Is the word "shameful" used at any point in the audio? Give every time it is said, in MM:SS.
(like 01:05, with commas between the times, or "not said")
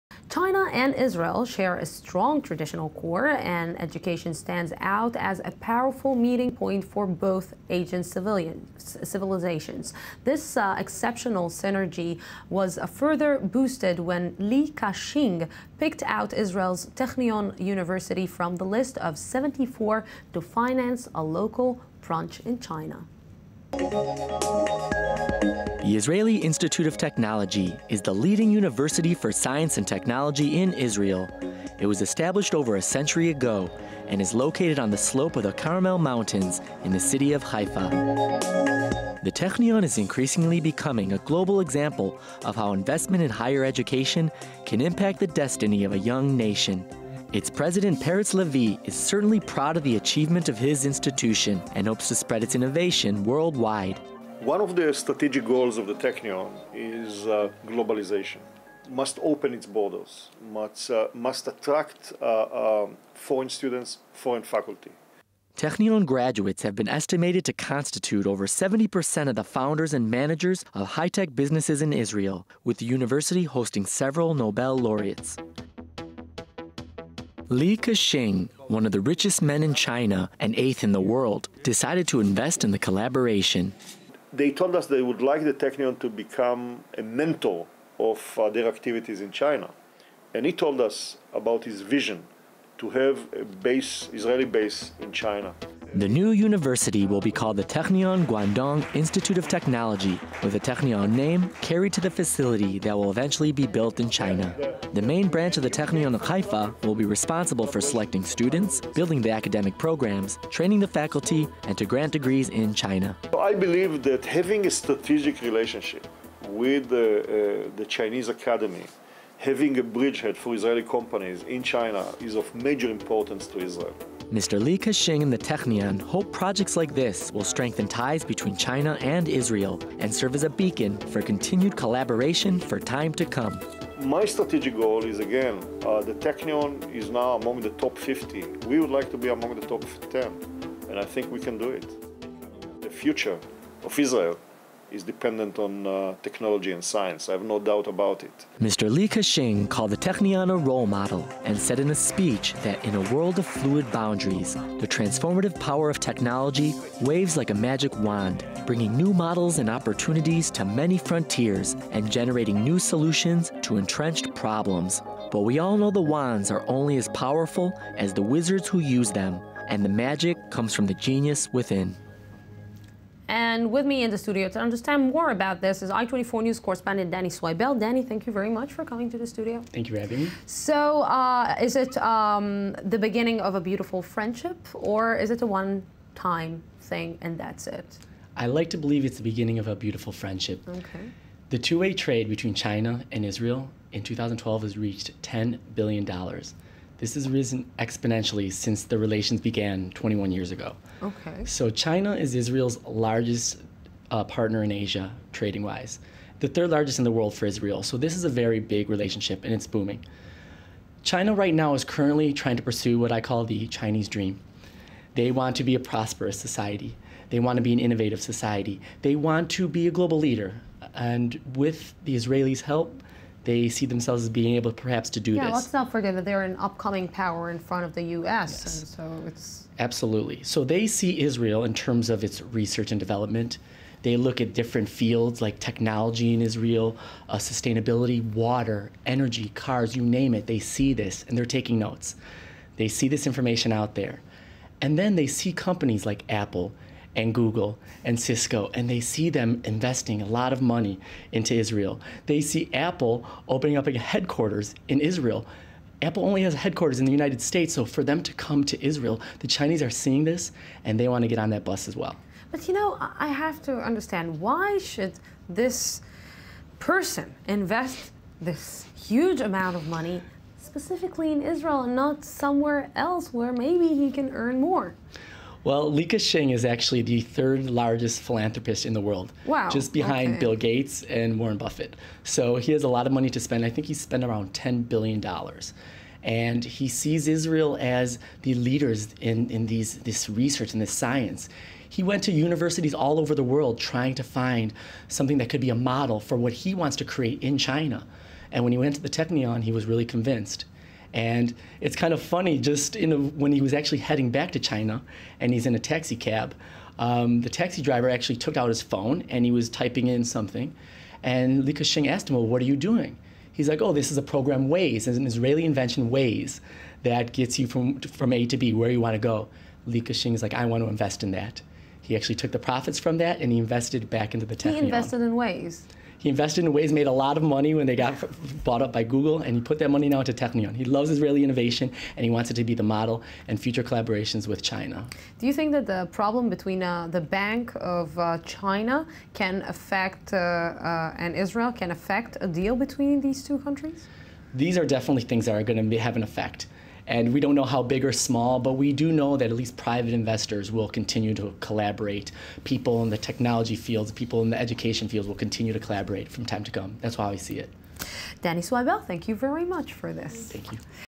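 not said.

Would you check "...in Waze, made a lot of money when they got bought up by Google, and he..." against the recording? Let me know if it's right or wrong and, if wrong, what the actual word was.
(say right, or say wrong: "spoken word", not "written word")
right.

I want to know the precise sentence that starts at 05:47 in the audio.
And we don't know how big or small, but we do know that at least private investors will continue to collaborate.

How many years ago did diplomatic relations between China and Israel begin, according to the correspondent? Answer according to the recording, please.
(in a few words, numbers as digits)
21.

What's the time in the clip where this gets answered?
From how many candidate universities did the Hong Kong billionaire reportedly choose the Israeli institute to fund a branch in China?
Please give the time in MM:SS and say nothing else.
00:19.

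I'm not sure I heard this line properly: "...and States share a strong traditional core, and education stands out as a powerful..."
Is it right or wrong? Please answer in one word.
wrong.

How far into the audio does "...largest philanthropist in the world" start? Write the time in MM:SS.
04:37.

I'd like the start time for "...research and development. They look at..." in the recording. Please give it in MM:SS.
03:52.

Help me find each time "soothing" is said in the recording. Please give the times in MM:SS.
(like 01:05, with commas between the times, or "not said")
not said.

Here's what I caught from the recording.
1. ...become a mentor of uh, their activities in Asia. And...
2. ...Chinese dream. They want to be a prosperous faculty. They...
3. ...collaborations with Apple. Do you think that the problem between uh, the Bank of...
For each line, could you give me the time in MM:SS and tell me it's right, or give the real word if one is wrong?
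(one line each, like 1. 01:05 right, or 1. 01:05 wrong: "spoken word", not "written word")
1. 01:26 wrong: "China", not "Asia"
2. 03:33 wrong: "society", not "faculty"
3. 05:33 wrong: "China", not "Apple".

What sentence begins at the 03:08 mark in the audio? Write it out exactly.
I like to believe it's the beginning of a beautiful friendship.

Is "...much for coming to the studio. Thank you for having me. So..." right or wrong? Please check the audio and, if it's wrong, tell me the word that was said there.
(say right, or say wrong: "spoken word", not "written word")
right.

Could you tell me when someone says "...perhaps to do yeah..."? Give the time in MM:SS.
03:44.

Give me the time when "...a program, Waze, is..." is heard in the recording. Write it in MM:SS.
05:14.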